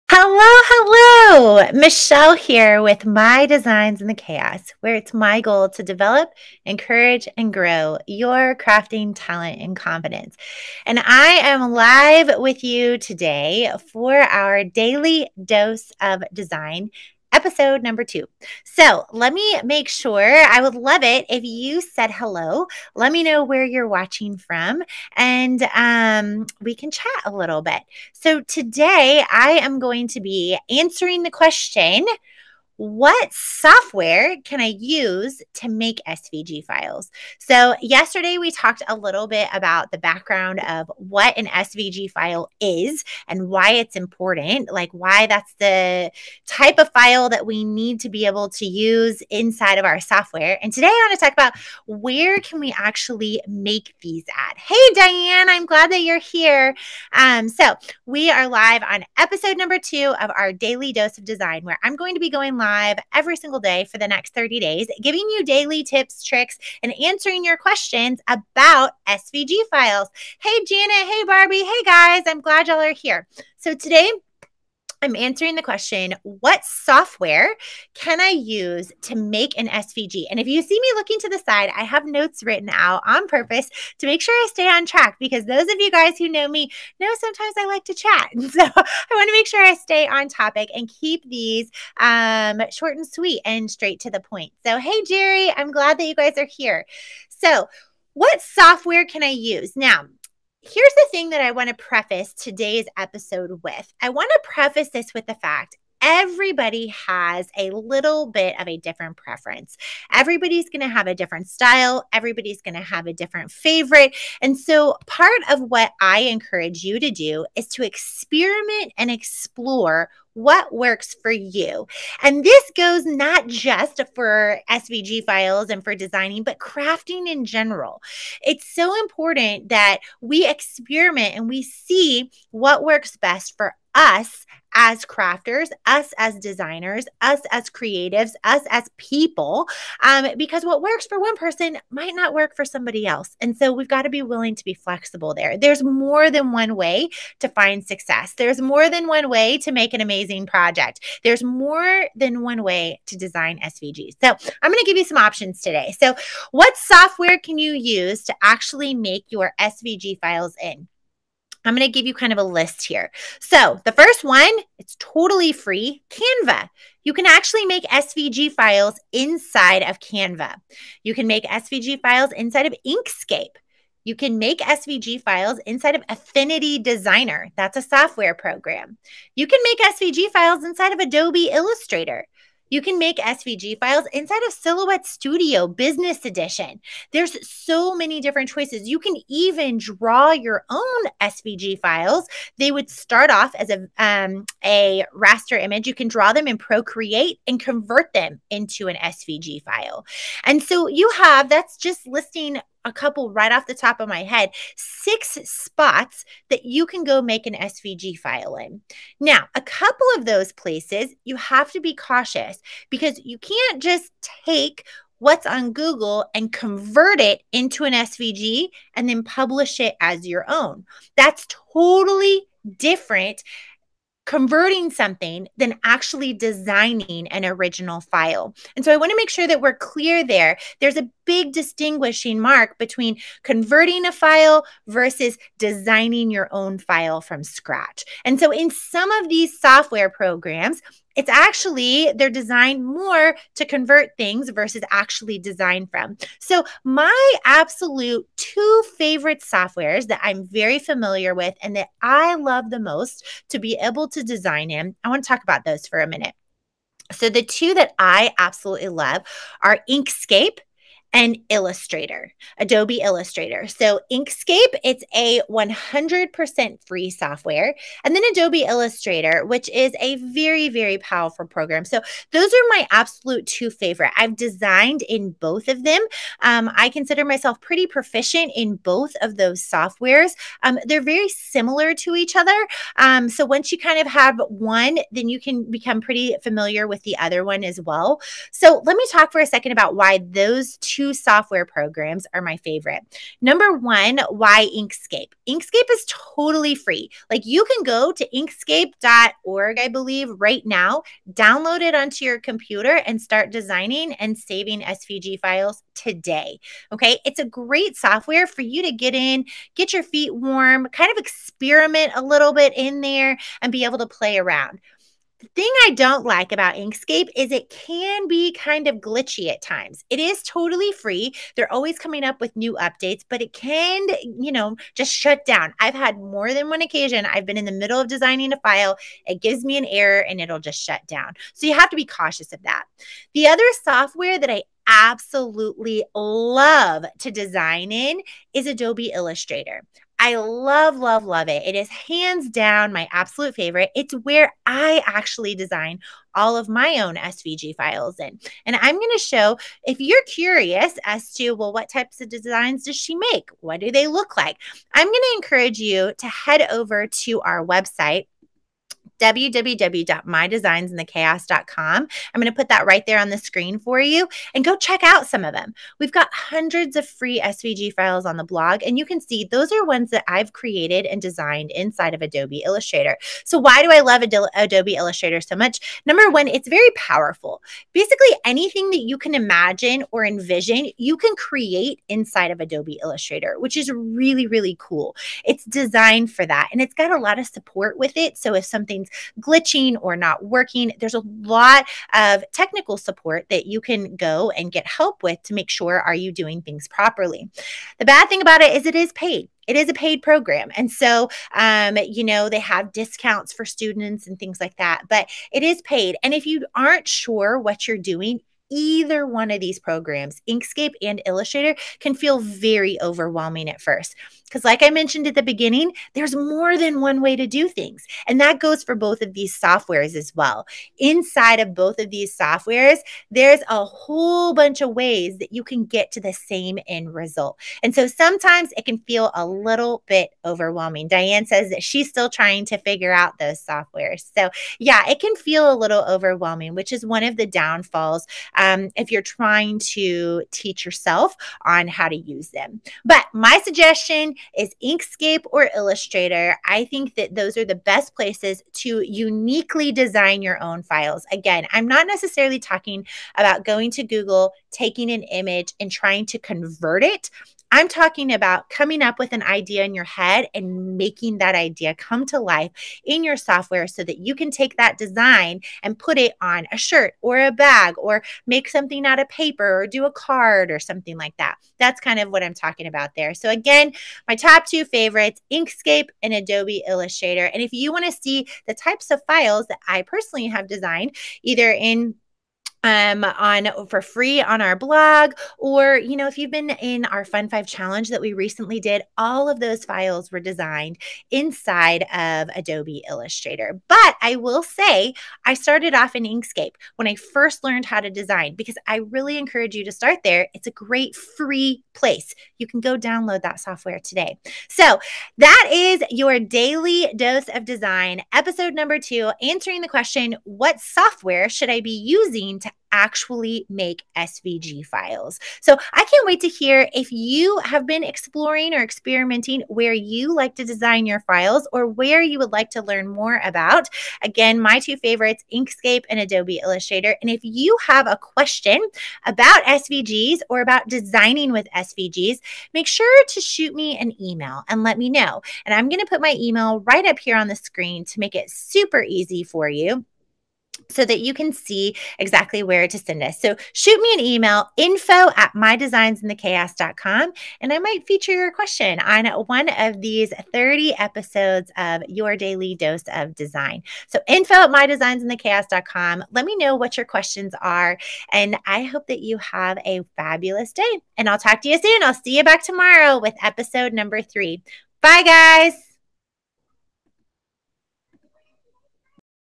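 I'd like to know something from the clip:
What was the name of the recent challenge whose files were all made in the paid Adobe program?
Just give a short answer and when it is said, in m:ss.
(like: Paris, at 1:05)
Fun Five Challenge, at 8:07.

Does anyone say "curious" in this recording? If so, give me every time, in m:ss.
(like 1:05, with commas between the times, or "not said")
5:50.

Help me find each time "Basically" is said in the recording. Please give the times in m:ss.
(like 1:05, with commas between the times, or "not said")
6:17.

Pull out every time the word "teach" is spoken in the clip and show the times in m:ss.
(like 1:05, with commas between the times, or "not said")
7:20.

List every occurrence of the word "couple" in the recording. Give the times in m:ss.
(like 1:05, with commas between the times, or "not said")
3:22, 3:29.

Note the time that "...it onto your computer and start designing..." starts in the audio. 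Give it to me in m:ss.
5:01.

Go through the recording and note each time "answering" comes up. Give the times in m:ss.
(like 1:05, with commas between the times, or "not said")
0:30, 1:07, 1:15, 8:29.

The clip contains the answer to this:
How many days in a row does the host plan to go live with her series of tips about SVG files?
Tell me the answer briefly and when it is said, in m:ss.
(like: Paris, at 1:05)
30, at 1:04.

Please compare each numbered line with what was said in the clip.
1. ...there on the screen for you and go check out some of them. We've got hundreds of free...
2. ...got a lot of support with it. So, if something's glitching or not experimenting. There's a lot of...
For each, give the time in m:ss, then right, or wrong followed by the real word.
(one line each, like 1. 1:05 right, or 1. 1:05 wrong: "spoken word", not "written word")
1. 6:03 right
2. 6:26 wrong: "working", not "experimenting".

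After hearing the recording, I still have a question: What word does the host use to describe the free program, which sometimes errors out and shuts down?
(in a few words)
glitchy.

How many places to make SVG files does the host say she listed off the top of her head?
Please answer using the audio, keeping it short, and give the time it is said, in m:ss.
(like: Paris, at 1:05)
6, at 3:24.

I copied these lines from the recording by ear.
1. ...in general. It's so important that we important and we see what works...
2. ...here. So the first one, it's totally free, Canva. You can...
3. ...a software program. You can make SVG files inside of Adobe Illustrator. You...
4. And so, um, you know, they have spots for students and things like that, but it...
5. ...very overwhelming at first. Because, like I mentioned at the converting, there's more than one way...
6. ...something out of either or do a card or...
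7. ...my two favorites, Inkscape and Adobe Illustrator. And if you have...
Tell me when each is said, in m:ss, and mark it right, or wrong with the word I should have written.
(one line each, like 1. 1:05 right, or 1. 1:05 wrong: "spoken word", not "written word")
1. 2:07 wrong: "experiment", not "important"
2. 2:42 right
3. 2:57 right
4. 6:40 wrong: "discounts", not "spots"
5. 6:52 wrong: "beginning", not "converting"
6. 7:48 wrong: "paper", not "either"
7. 8:44 right.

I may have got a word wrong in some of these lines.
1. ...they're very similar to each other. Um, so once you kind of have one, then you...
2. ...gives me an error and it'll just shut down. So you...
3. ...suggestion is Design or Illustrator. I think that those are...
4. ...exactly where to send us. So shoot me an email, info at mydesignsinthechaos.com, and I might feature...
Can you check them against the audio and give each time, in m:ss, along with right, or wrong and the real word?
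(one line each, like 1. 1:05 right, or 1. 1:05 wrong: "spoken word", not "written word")
1. 4:40 right
2. 5:29 right
3. 7:23 wrong: "Inkscape", not "Design"
4. 9:02 right.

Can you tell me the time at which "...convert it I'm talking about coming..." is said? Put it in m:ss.
7:36.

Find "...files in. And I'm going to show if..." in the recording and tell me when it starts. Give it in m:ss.
5:47.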